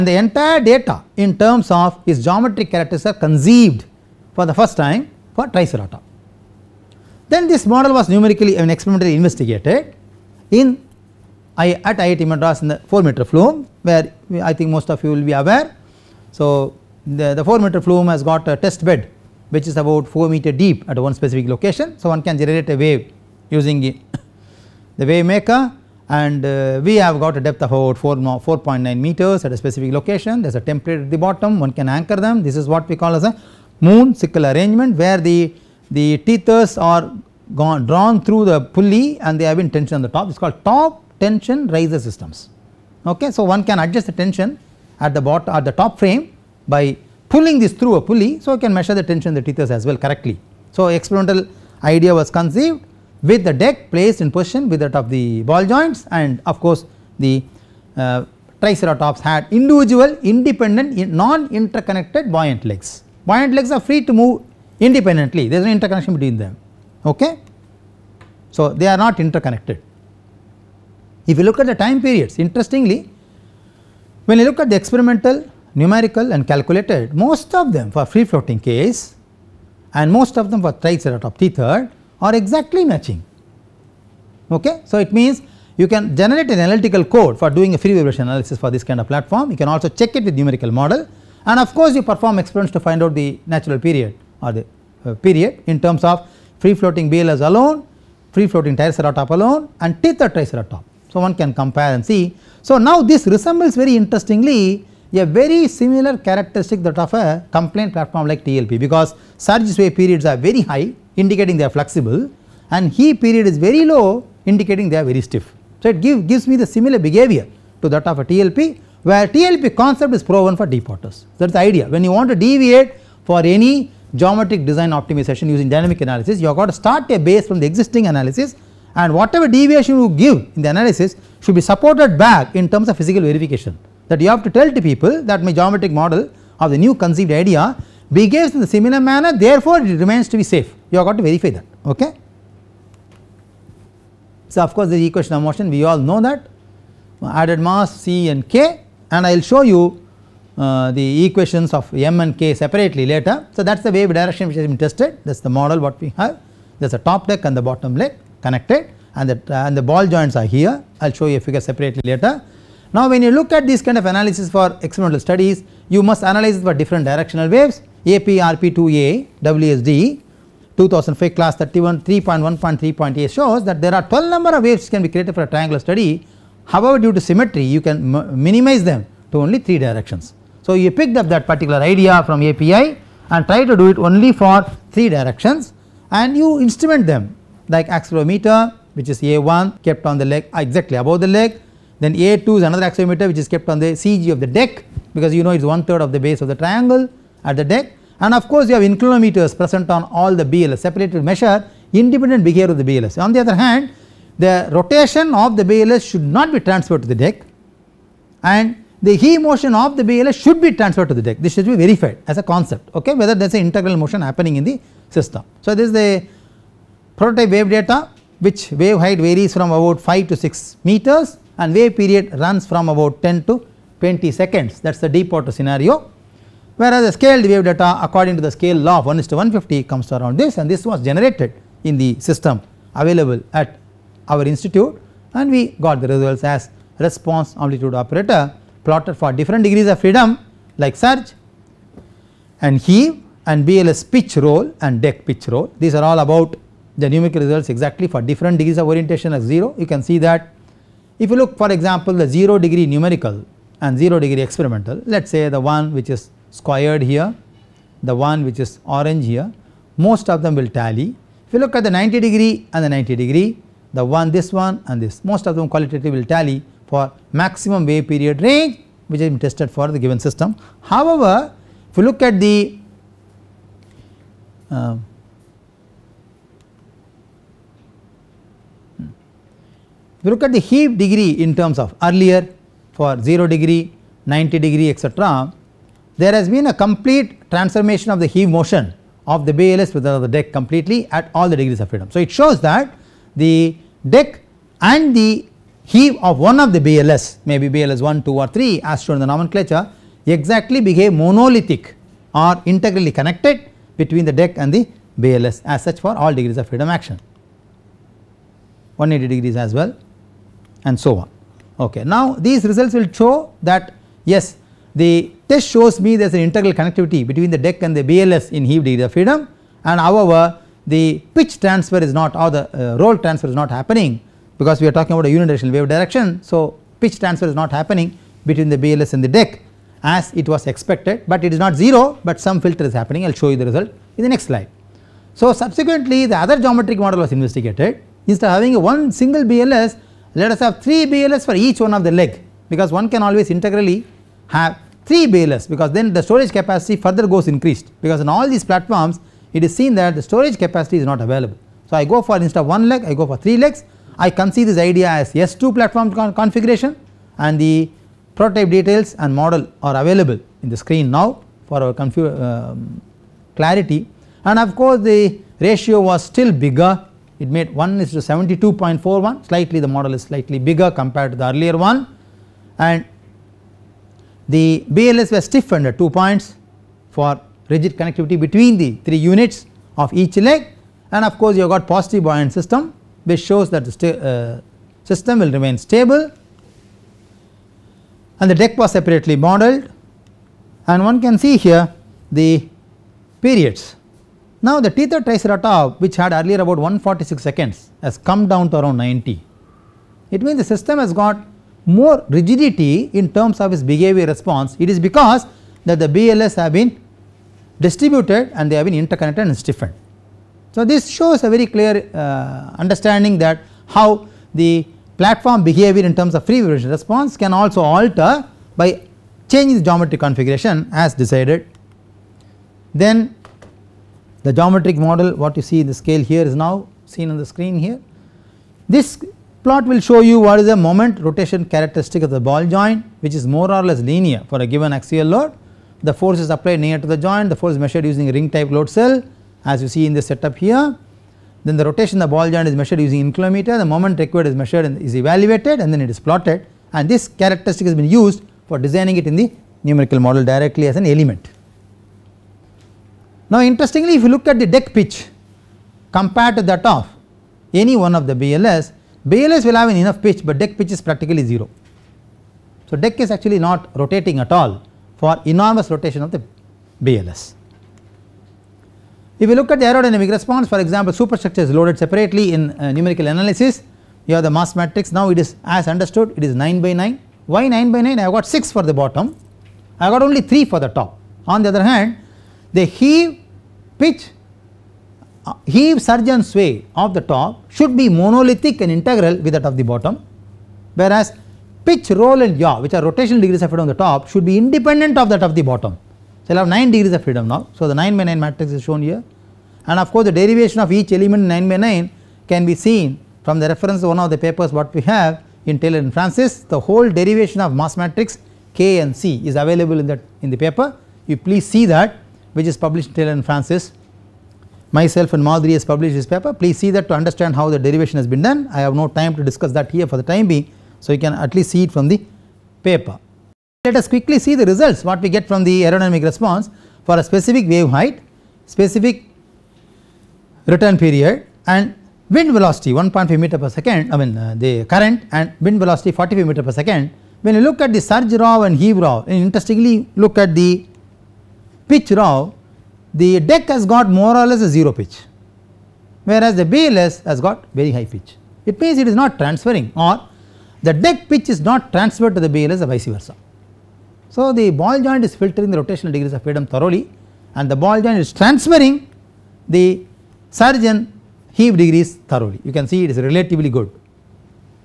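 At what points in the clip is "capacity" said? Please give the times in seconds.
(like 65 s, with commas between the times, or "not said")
346 s, 350 s.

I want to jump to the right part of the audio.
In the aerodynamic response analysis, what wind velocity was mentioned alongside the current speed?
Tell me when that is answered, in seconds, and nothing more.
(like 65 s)
536 s.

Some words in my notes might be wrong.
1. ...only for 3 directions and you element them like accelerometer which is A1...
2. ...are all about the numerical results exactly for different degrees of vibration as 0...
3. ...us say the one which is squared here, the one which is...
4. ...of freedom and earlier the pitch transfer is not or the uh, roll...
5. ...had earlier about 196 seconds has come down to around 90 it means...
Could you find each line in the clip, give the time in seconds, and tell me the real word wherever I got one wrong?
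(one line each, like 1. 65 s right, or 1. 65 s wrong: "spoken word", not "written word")
1. 183 s wrong: "instrument", not "element"
2. 245 s wrong: "orientation", not "vibration"
3. 255 s right
4. 319 s wrong: "however", not "earlier"
5. 396 s wrong: "146", not "196".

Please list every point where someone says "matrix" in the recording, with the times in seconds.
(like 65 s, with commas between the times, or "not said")
474 s, 498 s, 507 s.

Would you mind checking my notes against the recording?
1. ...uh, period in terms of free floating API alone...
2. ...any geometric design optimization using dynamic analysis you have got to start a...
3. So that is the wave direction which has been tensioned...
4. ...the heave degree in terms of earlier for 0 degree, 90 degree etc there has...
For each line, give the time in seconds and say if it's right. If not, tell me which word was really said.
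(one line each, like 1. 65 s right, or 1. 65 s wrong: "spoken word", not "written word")
1. 95 s wrong: "BLS", not "API"
2. 123 s right
3. 153 s wrong: "tested", not "tensioned"
4. 280 s right.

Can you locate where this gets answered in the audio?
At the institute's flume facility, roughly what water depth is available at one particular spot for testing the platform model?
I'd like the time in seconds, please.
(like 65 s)
28 s.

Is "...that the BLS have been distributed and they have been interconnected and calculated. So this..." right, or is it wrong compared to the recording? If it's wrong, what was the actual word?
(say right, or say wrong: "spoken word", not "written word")
wrong: "stiffened", not "calculated".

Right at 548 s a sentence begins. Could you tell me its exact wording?
It means it is not transferring or the deck pitch is not transferred to the BLS or vice versa.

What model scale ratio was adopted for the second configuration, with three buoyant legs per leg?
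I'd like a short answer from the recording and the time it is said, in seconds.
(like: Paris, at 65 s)
1:72.41, at 367 s.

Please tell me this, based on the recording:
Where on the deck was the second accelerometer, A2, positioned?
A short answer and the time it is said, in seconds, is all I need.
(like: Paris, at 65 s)
the CG, at 193 s.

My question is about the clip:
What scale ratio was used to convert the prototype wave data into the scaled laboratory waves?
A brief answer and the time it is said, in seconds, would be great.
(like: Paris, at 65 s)
1:150, at 229 s.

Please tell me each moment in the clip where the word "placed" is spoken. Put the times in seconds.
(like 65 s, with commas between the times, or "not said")
53 s.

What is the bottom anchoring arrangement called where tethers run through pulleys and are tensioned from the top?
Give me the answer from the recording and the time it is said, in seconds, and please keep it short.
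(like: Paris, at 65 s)
moon sickle arrangement, at 33 s.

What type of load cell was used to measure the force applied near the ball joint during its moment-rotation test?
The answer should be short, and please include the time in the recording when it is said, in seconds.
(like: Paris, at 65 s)
ring type load cell, at 438 s.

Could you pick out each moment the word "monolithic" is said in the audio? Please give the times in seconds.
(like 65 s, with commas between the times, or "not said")
301 s, 488 s.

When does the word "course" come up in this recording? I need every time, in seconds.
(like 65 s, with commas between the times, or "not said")
56 s, 91 s, 144 s, 198 s, 364 s, 381 s, 500 s.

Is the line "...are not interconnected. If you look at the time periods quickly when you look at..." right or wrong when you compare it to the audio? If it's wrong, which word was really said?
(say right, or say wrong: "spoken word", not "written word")
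wrong: "interestingly", not "quickly".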